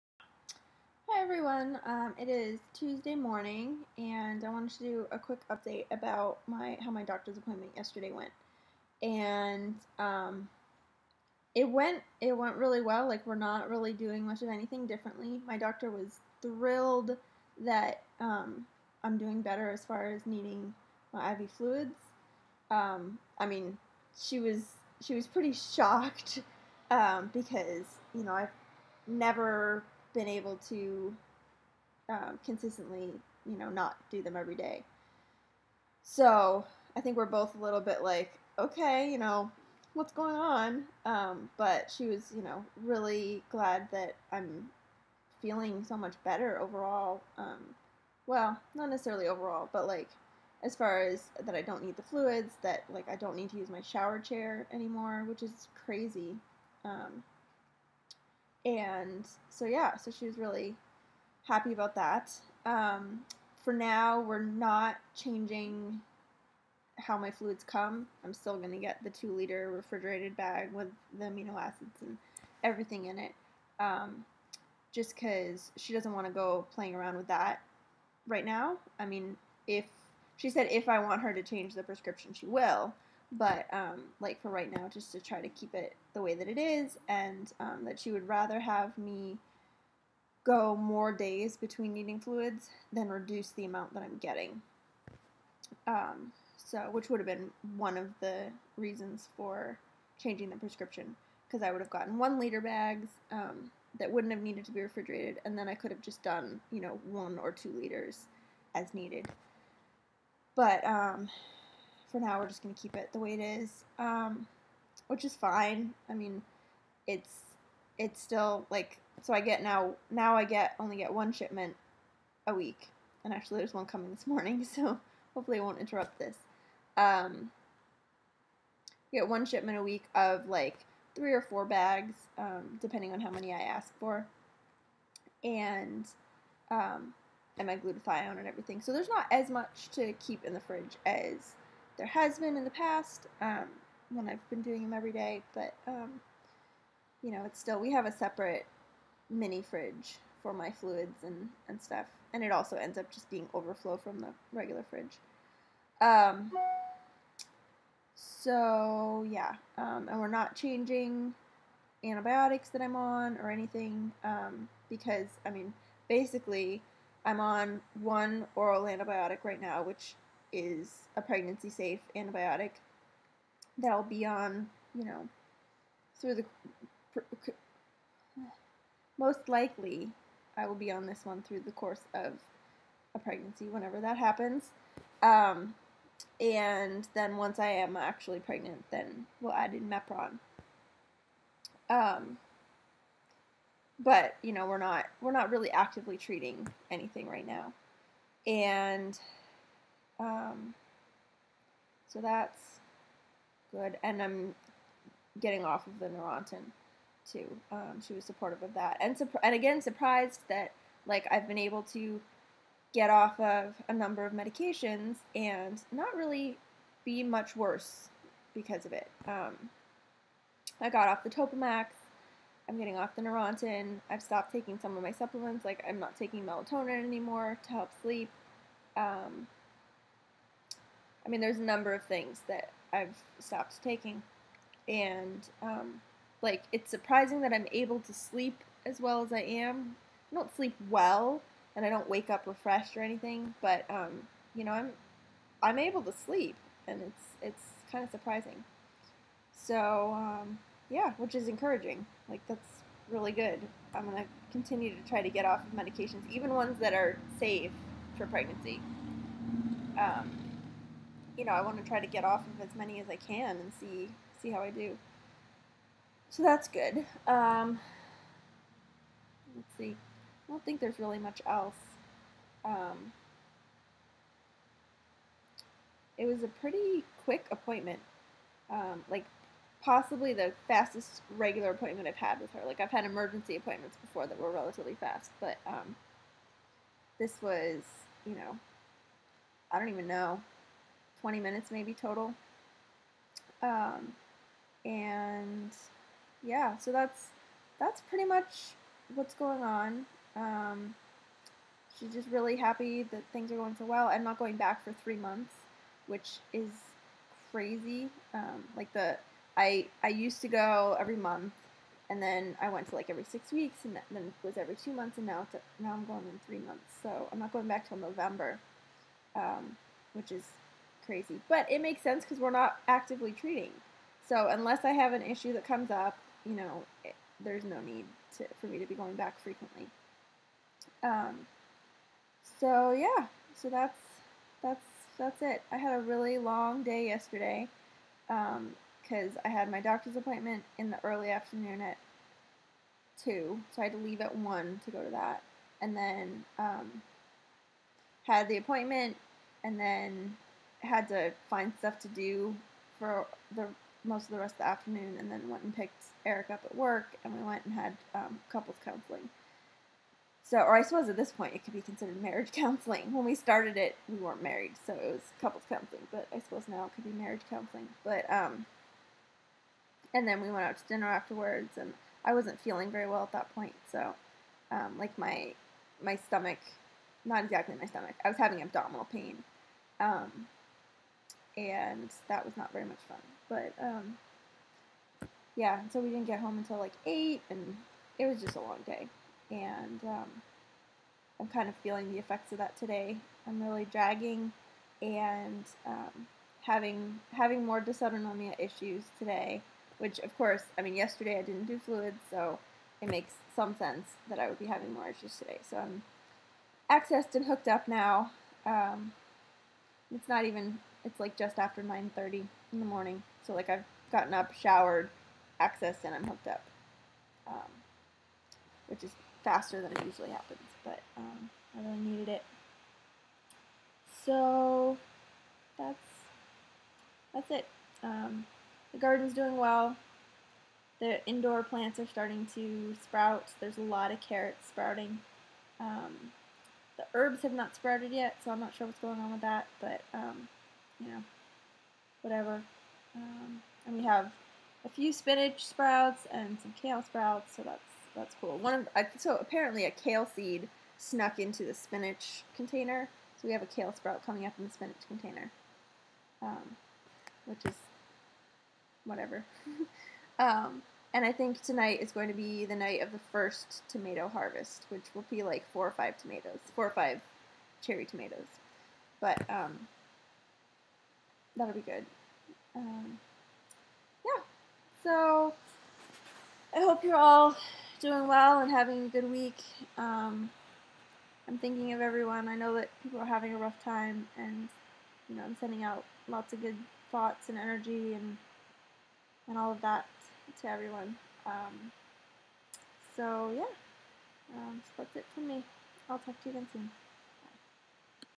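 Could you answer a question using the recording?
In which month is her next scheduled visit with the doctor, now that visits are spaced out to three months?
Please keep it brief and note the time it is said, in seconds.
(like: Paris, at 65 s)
November, at 317 s.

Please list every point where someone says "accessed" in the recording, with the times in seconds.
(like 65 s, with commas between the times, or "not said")
406 s, 415 s.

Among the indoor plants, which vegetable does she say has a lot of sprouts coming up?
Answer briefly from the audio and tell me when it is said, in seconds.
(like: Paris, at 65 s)
Carrots, at 434 s.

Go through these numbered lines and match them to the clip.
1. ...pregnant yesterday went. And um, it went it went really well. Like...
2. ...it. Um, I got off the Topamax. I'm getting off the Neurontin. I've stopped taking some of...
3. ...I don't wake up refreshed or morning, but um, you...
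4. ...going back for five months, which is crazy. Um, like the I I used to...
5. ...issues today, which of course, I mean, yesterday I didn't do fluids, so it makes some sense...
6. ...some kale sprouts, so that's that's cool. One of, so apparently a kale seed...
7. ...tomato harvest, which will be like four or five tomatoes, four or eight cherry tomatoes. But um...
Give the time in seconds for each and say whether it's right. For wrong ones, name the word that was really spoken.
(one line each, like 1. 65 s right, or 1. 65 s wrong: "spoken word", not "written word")
1. 7 s wrong: "appointment", not "pregnant"
2. 218 s right
3. 241 s wrong: "anything", not "morning"
4. 304 s wrong: "three", not "five"
5. 398 s right
6. 446 s right
7. 463 s wrong: "five", not "eight".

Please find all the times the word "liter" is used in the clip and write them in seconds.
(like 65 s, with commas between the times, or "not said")
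69 s, 102 s, 107 s.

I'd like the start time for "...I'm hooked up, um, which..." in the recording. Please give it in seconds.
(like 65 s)
416 s.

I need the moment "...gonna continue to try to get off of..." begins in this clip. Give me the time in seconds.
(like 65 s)
254 s.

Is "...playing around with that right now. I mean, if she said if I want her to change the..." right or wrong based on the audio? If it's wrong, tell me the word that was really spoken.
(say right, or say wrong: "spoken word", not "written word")
right.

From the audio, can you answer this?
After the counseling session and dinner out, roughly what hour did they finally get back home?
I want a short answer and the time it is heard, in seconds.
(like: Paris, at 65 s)
8, at 387 s.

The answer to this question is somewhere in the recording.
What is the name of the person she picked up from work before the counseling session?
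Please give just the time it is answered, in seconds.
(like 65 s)
356 s.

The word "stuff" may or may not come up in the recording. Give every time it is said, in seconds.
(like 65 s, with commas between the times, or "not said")
151 s, 351 s.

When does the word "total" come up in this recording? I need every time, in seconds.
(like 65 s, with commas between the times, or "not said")
291 s.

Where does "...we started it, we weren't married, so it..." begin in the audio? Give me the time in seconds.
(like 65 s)
363 s.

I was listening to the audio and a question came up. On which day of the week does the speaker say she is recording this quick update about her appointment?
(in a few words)
Tuesday.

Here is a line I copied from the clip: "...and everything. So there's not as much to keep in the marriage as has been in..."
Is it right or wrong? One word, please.
wrong.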